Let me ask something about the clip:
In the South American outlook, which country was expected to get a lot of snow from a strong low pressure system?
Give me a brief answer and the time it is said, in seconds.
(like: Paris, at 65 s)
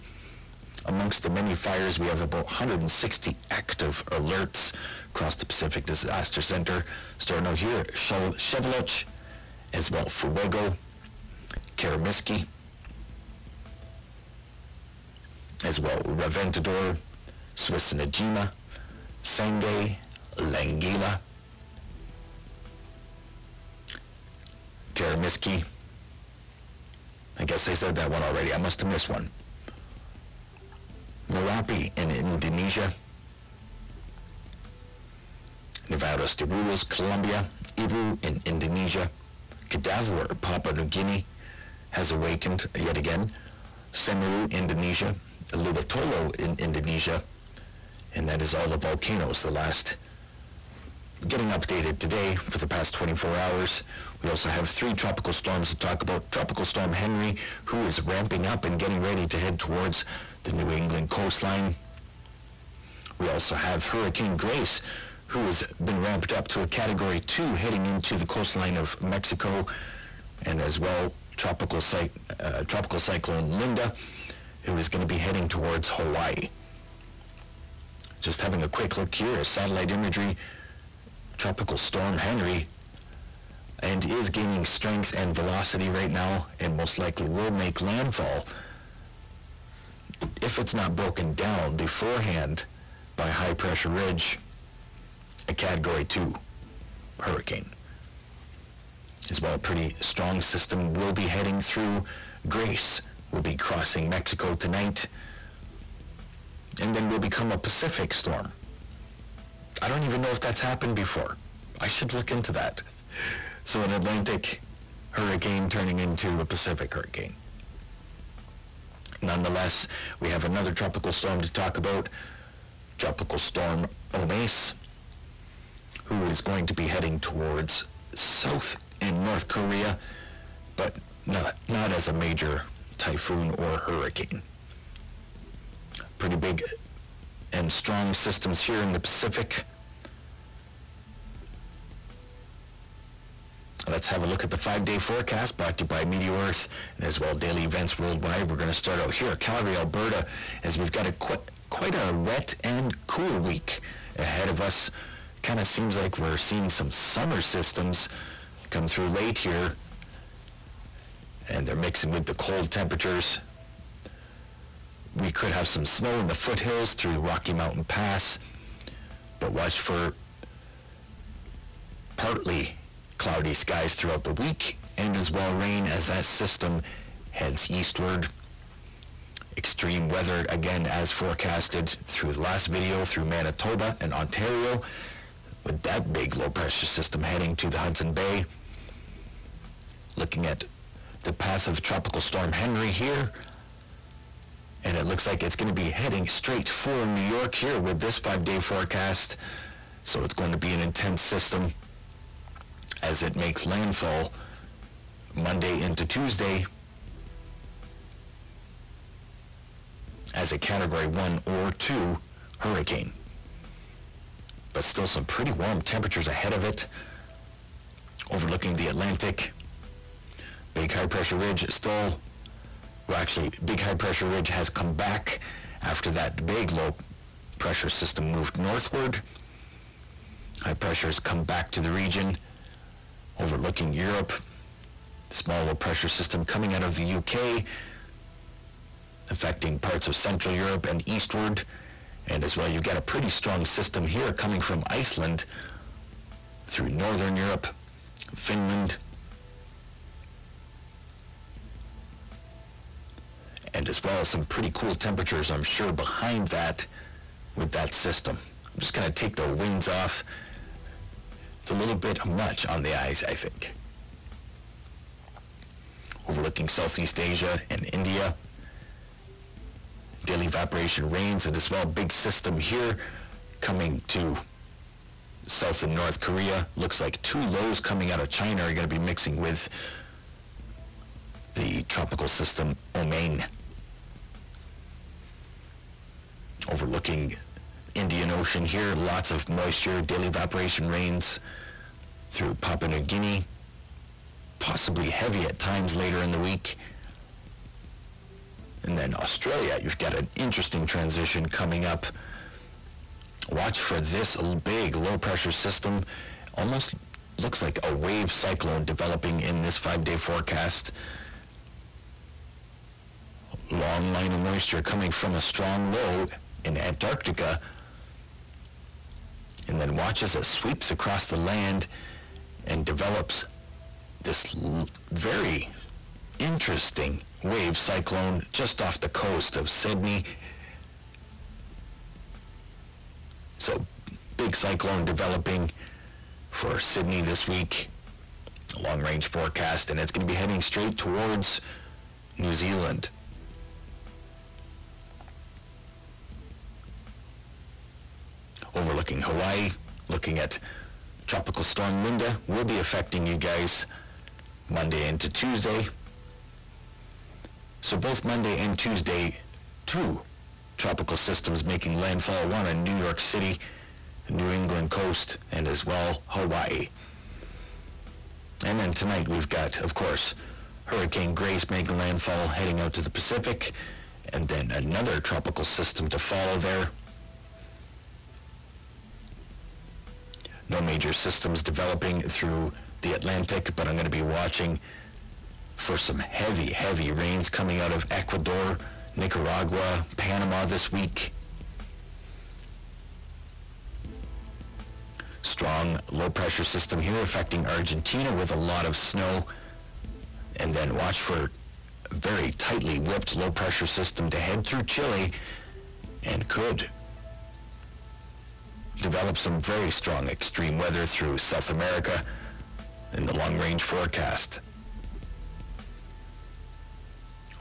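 Argentina, at 397 s.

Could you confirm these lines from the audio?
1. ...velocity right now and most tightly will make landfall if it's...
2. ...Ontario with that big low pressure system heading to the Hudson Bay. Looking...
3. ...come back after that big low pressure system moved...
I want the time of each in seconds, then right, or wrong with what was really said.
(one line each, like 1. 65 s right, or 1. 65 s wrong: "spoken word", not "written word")
1. 85 s wrong: "likely", not "tightly"
2. 184 s right
3. 224 s right.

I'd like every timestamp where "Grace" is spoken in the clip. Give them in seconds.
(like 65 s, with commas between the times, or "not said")
64 s, 102 s, 371 s.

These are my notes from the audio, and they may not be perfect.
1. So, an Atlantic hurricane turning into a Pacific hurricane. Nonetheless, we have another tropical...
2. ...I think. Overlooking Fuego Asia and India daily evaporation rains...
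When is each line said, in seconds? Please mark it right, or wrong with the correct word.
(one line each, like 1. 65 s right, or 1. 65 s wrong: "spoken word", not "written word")
1. 113 s right
2. 263 s wrong: "Southeast", not "Fuego".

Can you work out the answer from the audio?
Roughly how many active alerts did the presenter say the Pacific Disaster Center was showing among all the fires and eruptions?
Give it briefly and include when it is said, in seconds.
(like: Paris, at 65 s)
160, at 2 s.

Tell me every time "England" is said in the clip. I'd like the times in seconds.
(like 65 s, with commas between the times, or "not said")
60 s, 364 s.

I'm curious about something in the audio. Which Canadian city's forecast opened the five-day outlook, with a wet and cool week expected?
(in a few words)
Calgary.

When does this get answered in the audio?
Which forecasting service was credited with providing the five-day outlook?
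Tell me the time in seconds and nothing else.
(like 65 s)
146 s.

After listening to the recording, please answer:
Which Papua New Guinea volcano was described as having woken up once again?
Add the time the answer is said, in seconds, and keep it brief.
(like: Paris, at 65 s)
Kadovar, at 39 s.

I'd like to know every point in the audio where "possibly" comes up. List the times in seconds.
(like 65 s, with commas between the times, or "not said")
294 s.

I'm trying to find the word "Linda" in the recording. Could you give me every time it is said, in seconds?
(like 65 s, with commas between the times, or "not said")
73 s, 352 s.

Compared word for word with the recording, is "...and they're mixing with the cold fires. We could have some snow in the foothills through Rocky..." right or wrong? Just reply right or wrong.
wrong.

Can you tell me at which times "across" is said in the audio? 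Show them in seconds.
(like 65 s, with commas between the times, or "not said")
5 s, 320 s.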